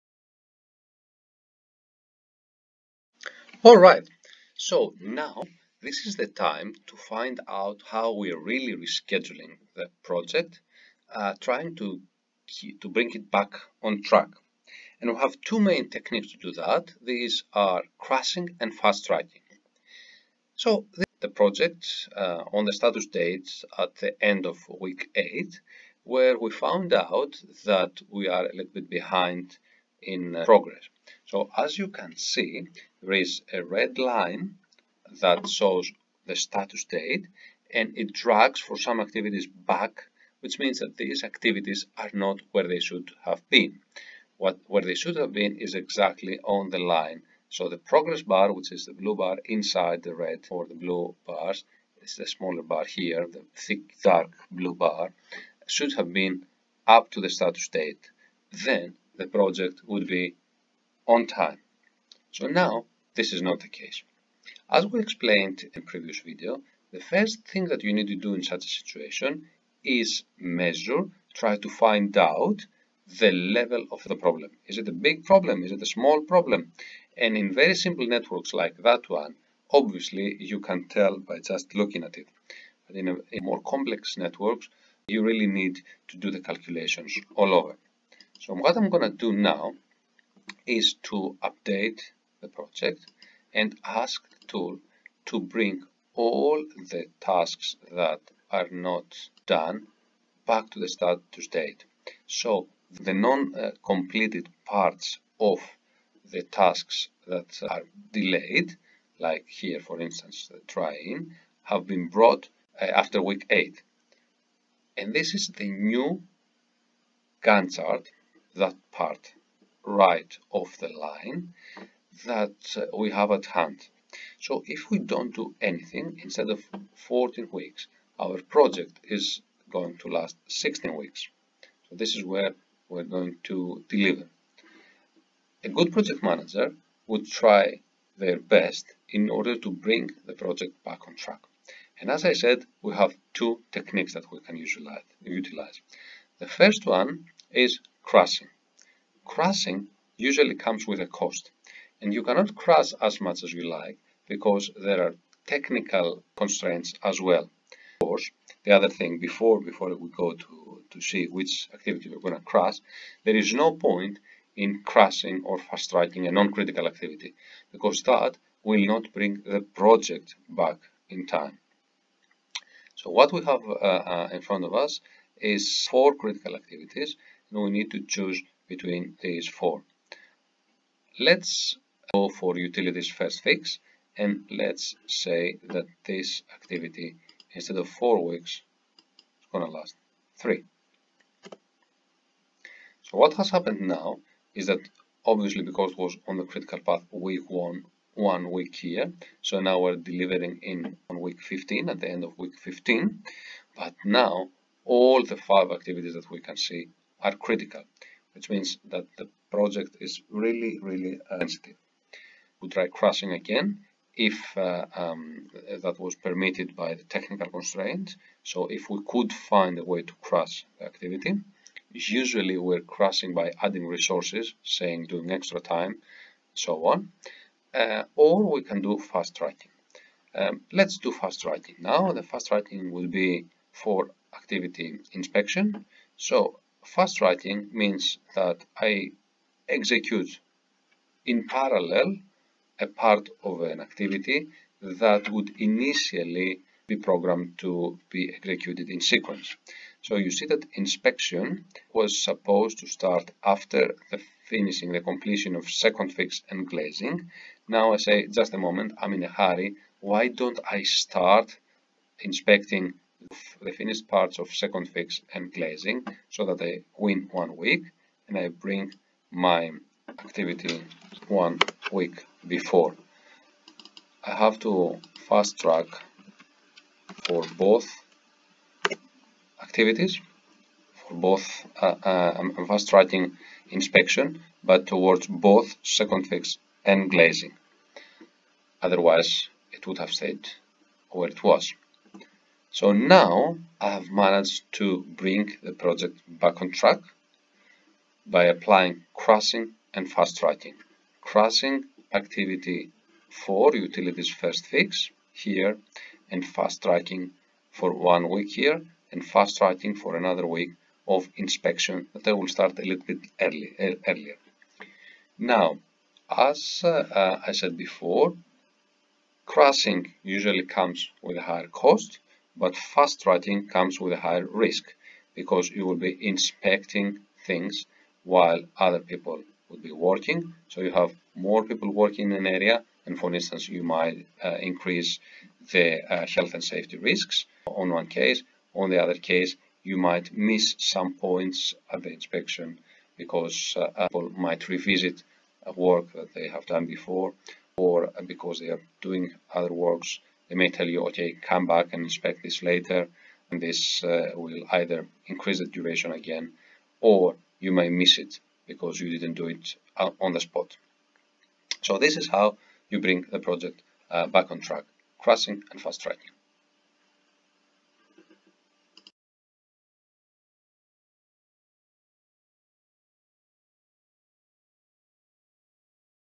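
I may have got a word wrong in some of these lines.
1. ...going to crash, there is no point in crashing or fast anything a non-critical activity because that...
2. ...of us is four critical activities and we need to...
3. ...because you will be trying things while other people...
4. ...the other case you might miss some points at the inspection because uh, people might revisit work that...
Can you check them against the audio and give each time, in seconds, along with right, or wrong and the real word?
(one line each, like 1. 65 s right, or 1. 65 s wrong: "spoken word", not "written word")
1. 162 s wrong: "tracking", not "anything"
2. 174 s right
3. 325 s wrong: "inspecting", not "trying"
4. 338 s right.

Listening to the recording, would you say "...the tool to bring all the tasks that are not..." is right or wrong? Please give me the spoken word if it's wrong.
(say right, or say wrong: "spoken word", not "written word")
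right.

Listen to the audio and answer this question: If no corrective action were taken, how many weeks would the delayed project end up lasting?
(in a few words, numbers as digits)
16.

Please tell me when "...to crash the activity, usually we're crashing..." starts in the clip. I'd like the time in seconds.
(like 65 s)
220 s.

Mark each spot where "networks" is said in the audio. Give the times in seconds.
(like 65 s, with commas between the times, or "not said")
78 s, 84 s.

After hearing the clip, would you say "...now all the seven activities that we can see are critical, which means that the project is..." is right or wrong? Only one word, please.
wrong.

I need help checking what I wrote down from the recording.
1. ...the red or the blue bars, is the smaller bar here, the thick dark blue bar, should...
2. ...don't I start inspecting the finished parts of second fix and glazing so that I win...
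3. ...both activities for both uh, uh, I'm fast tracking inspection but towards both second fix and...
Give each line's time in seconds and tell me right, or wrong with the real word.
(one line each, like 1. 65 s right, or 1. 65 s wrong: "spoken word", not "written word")
1. 50 s right
2. 260 s right
3. 277 s right.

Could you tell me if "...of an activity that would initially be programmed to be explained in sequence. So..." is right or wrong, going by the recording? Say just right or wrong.
wrong.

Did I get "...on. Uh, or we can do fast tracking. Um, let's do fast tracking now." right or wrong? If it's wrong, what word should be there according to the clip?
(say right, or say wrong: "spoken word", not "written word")
right.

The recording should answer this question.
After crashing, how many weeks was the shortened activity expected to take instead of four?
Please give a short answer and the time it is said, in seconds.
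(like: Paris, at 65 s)
3, at 190 s.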